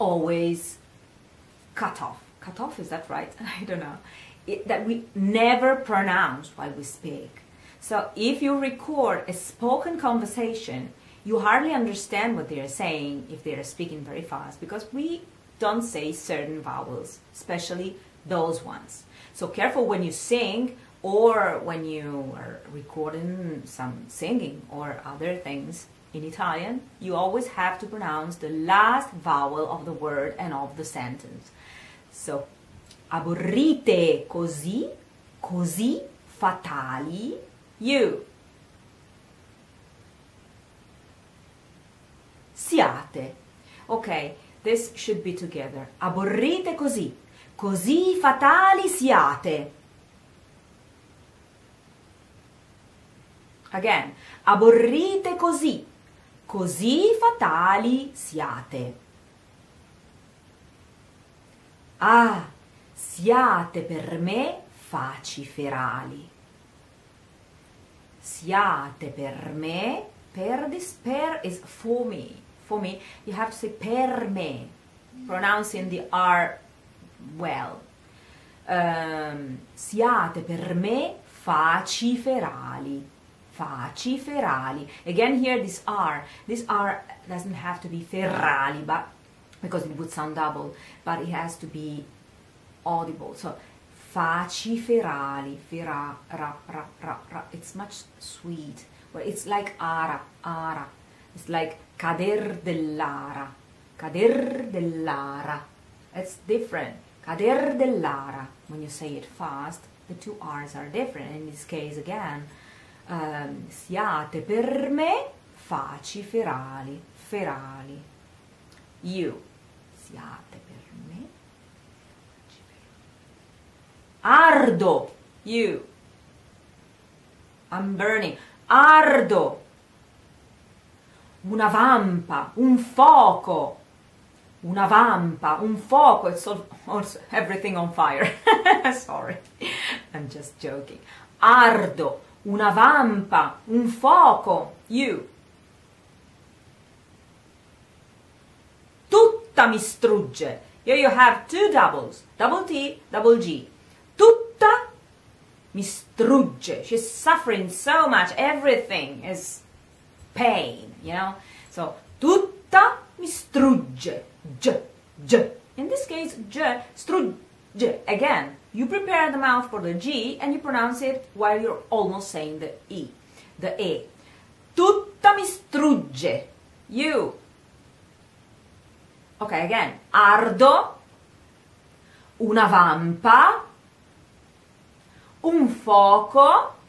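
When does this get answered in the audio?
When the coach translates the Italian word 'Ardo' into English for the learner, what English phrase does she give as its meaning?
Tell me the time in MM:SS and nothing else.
02:07.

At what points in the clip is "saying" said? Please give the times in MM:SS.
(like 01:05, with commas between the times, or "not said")
00:12, 02:52.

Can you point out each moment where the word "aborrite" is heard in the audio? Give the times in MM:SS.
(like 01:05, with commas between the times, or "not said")
00:33, 00:46, 00:54.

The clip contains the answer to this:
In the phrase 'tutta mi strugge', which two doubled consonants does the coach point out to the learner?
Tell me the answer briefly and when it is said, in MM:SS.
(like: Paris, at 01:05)
double T, double G, at 02:32.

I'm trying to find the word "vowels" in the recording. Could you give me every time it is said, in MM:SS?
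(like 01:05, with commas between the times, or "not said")
00:16, 00:29.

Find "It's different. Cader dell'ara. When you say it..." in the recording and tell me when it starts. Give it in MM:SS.
01:46.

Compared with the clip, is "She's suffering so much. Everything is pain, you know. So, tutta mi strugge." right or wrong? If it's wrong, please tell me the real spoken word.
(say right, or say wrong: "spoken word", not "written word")
right.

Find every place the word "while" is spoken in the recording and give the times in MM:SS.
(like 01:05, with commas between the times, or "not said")
00:06, 02:51.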